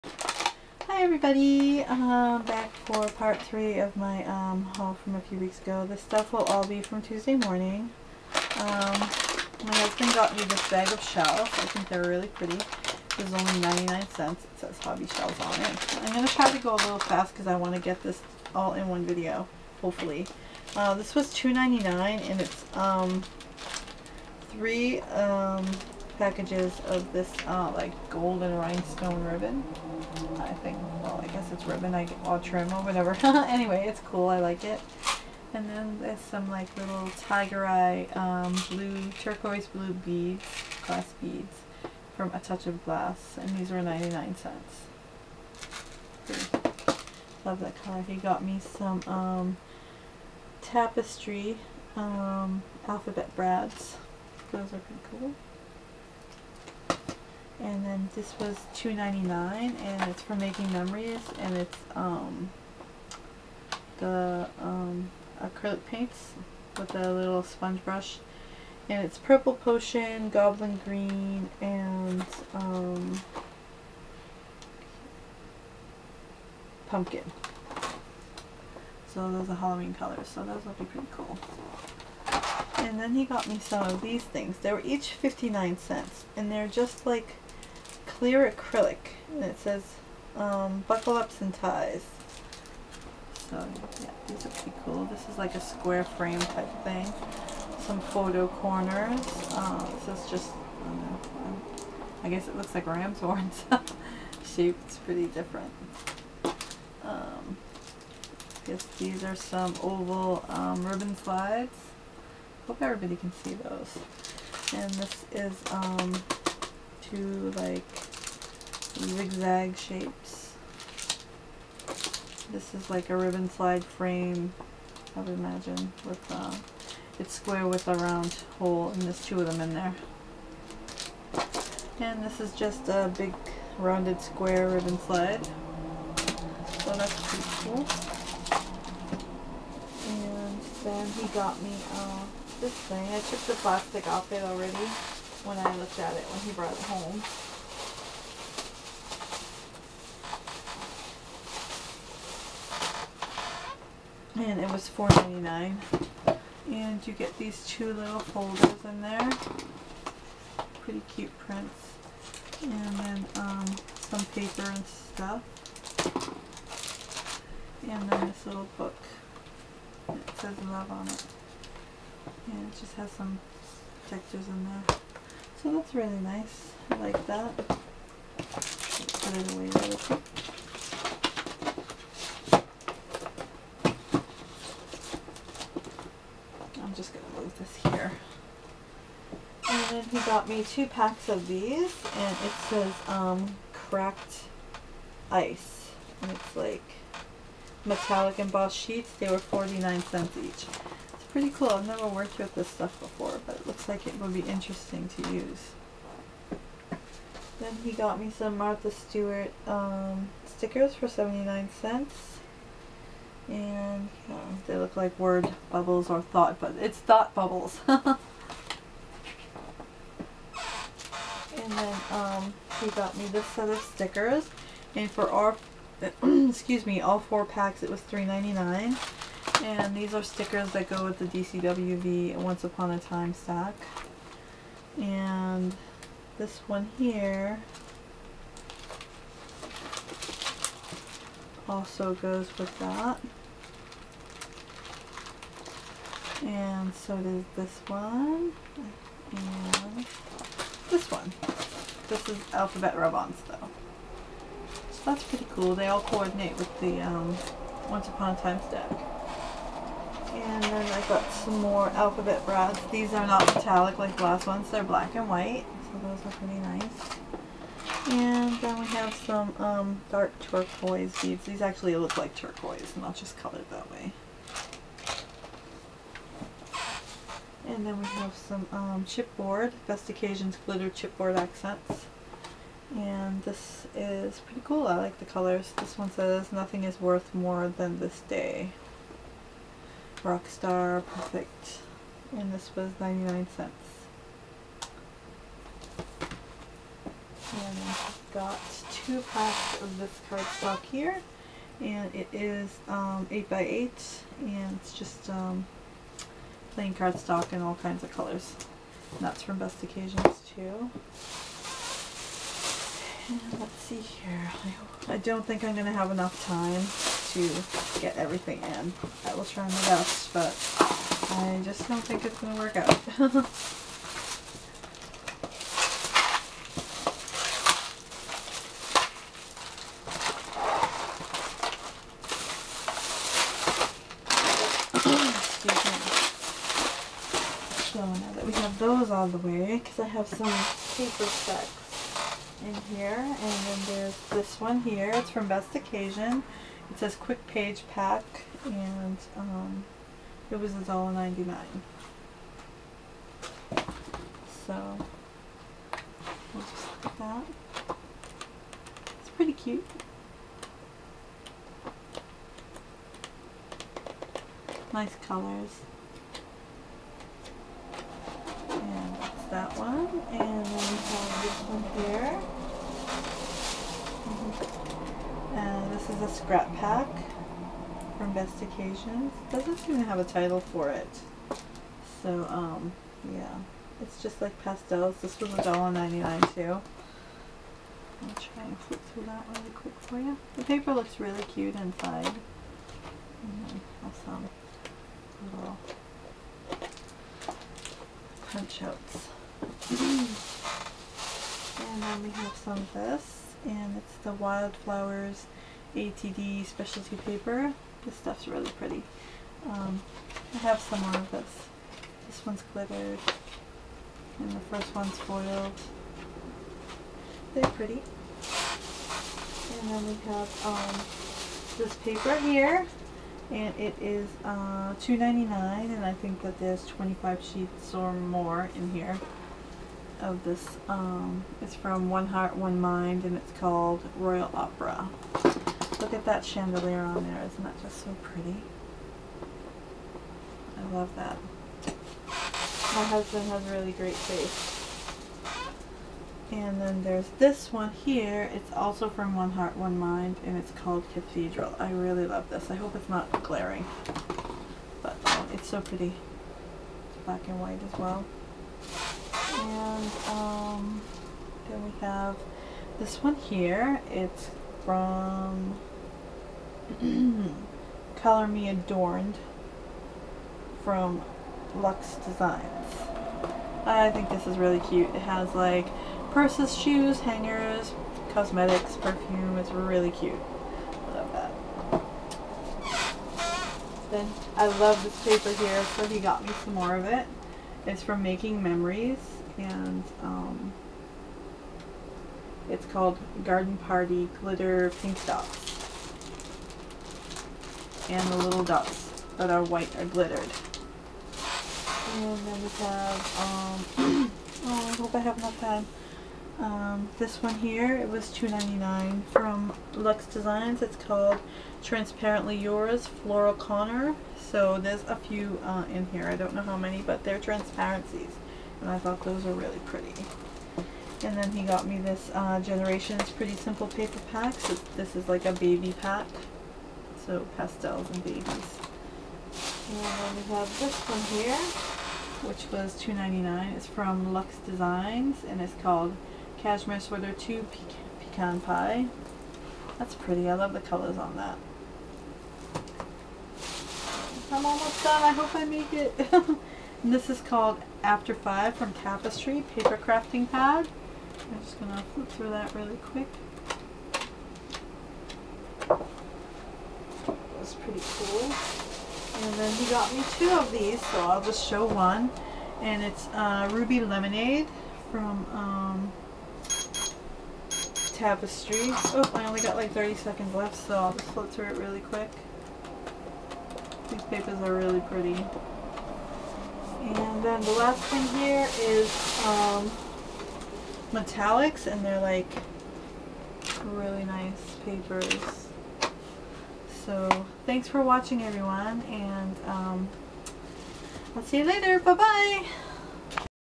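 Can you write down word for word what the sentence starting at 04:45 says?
This one says, nothing is worth more than this day.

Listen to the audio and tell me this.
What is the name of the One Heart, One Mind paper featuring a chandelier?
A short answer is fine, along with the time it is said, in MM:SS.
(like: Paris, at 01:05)
Royal Opera, at 07:14.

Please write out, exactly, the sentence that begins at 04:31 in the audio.
These actually look like turquoise, and I'll just colored it that way.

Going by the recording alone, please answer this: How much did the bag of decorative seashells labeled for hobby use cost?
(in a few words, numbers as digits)
99 cents.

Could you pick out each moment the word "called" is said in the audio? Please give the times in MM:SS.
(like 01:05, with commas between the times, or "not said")
07:13, 07:30, 08:12, 08:30, 08:55, 09:07.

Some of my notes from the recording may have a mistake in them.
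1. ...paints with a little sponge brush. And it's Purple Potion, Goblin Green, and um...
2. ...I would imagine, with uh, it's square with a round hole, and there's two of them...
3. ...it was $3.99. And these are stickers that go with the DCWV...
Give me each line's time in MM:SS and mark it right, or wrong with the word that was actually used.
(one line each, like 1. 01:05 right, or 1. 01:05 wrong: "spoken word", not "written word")
1. 01:05 right
2. 02:05 right
3. 03:47 right.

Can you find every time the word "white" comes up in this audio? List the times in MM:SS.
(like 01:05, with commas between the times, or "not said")
04:25, 07:37, 08:19.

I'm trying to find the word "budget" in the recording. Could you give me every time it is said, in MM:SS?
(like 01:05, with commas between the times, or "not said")
not said.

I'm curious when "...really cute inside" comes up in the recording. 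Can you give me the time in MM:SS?
06:31.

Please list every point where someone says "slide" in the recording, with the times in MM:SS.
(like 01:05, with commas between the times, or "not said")
01:51, 02:03, 02:14.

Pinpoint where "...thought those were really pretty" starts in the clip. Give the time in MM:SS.
08:38.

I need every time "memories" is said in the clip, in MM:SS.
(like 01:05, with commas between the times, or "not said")
01:00, 08:08.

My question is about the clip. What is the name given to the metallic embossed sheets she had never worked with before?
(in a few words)
Cracked ice.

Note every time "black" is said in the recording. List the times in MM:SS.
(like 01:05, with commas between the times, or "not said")
04:24, 07:37.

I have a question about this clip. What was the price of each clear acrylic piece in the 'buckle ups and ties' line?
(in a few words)
59 cents.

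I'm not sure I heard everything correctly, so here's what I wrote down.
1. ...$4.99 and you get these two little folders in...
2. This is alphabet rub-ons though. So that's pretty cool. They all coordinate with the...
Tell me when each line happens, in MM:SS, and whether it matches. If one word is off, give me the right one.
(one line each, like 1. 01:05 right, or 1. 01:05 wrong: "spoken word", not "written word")
1. 02:34 right
2. 04:12 right.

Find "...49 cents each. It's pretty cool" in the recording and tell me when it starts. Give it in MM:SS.
03:19.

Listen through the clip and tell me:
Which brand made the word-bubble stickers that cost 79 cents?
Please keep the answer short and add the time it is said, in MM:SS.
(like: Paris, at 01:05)
Martha Stewart, at 03:28.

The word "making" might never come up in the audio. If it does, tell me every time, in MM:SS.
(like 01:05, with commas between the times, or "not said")
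01:00, 08:08.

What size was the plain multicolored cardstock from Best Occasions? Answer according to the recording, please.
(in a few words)
8x8.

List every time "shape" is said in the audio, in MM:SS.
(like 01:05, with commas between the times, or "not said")
01:44, 01:59.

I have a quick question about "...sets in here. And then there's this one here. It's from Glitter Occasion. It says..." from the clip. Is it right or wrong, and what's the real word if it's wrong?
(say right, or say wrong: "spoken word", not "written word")
wrong: "Best", not "Glitter".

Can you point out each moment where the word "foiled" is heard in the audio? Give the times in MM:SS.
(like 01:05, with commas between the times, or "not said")
06:55.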